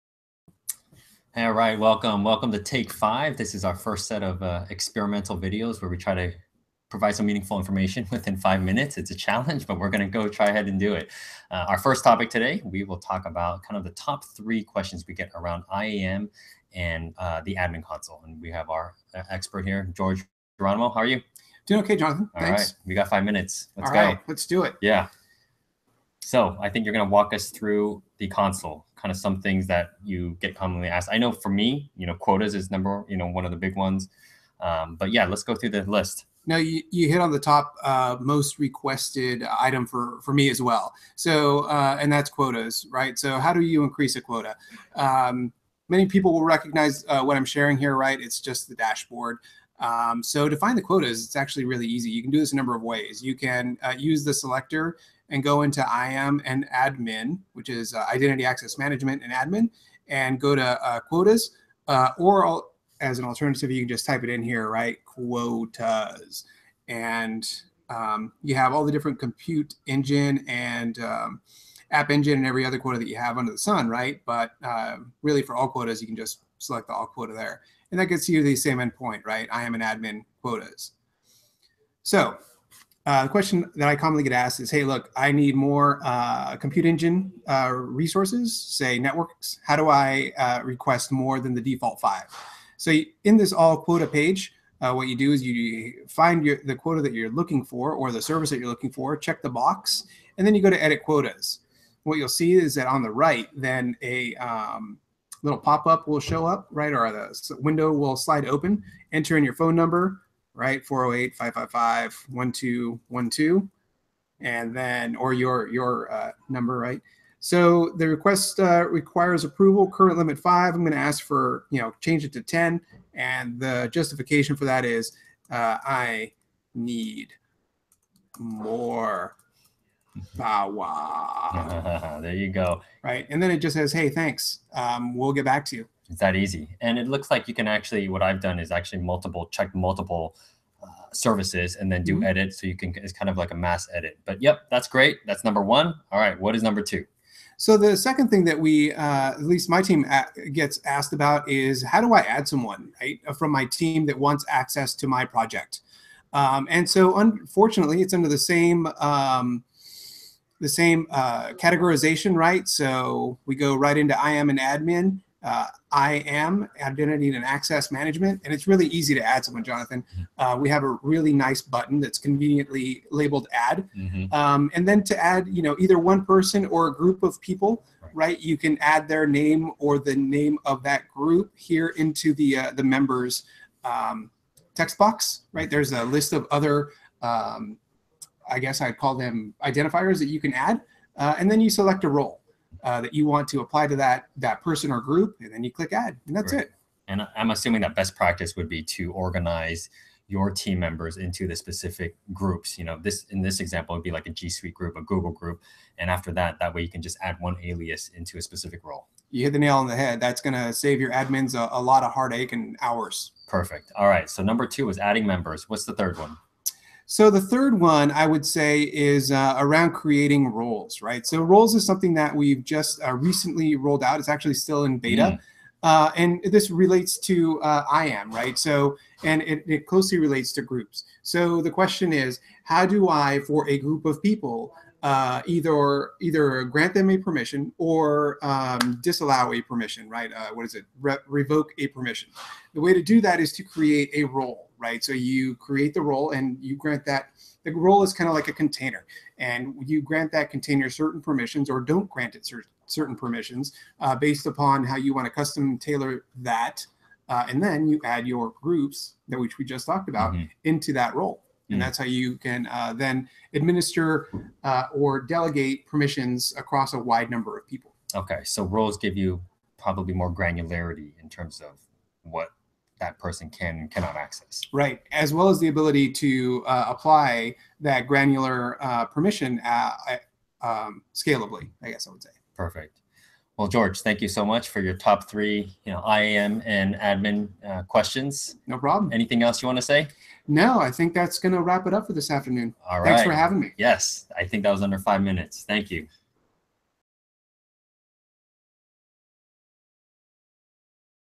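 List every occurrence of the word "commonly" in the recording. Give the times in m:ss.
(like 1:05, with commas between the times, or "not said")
0:30, 1:23.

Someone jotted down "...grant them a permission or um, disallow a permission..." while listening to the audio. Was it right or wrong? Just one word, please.
right.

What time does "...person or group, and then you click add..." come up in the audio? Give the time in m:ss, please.
3:14.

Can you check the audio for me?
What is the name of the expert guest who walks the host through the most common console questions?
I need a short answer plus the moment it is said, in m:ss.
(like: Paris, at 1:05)
George Geronimo, at 0:19.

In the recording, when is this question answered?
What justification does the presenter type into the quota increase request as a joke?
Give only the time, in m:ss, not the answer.
2:05.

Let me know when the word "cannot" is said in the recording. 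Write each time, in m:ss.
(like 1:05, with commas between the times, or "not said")
4:33.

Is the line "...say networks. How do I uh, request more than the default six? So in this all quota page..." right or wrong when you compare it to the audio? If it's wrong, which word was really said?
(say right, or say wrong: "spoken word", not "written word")
wrong: "five", not "six".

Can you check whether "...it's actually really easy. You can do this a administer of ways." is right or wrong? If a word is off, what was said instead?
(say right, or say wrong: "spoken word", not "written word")
wrong: "number", not "administer".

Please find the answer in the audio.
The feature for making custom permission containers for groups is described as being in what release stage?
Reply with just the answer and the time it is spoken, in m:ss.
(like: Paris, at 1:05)
beta, at 3:44.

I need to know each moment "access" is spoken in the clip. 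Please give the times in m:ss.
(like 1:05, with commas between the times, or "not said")
0:58, 2:34, 2:47, 4:34.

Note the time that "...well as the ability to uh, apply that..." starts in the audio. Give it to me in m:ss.
4:35.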